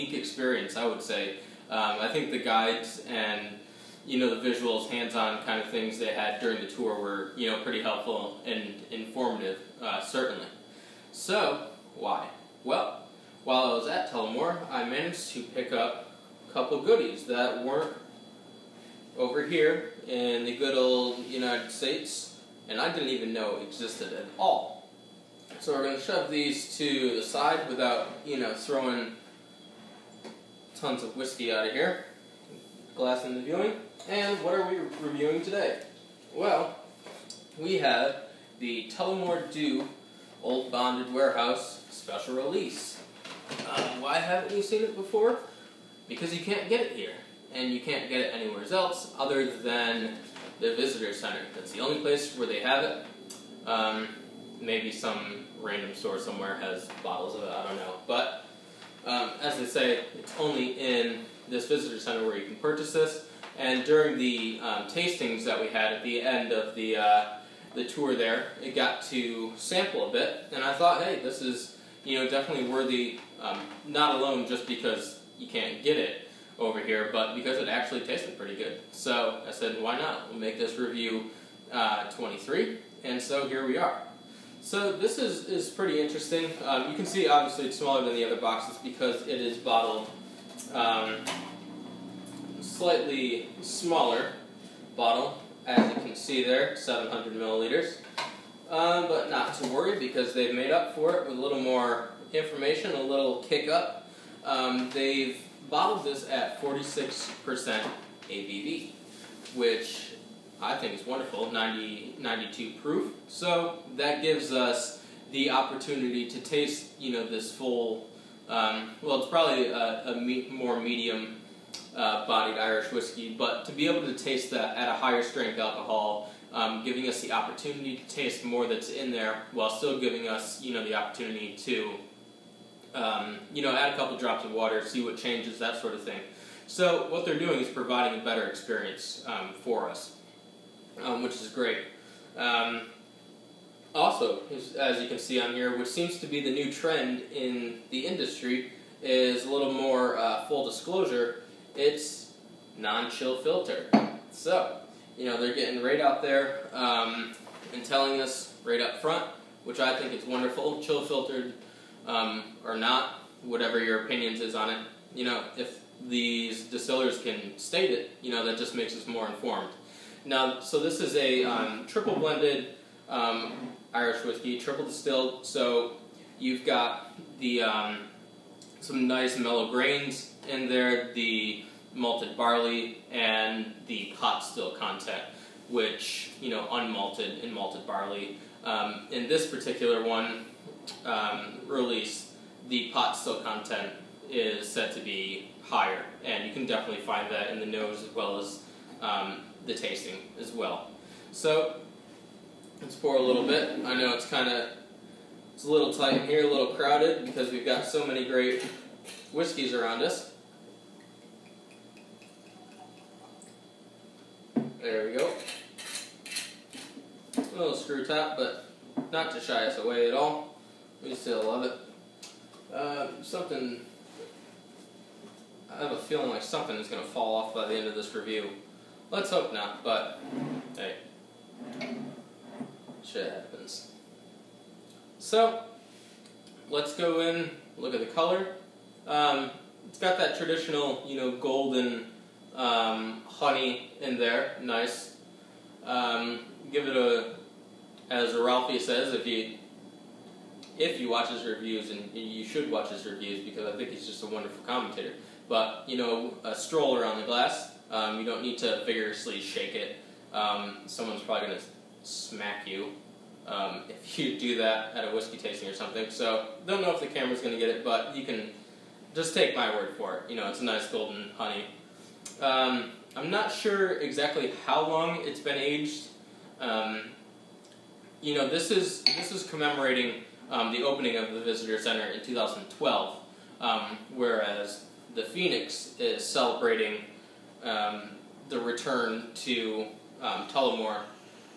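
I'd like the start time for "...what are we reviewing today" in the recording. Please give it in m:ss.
0:34.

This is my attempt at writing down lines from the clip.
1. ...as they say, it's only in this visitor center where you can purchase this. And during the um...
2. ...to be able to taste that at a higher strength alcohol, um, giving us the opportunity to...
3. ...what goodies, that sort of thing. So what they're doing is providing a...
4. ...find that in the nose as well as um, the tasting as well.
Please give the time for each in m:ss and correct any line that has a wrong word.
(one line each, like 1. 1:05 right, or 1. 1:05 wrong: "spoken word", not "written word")
1. 0:59 right
2. 2:03 right
3. 2:15 wrong: "changes", not "goodies"
4. 3:17 right.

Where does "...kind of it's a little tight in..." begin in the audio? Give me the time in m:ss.
3:24.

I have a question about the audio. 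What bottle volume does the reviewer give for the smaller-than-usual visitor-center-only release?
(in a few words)
700 ml.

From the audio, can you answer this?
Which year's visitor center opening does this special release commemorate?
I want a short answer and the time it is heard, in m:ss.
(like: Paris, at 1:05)
2012, at 4:42.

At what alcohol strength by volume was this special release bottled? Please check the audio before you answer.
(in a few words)
46%.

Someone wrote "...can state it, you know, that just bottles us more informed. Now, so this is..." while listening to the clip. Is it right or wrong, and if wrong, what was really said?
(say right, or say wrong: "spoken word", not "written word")
wrong: "makes", not "bottles".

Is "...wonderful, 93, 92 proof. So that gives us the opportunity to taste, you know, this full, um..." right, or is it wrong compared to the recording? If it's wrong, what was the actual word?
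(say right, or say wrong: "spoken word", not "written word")
wrong: "90", not "93".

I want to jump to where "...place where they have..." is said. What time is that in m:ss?
0:52.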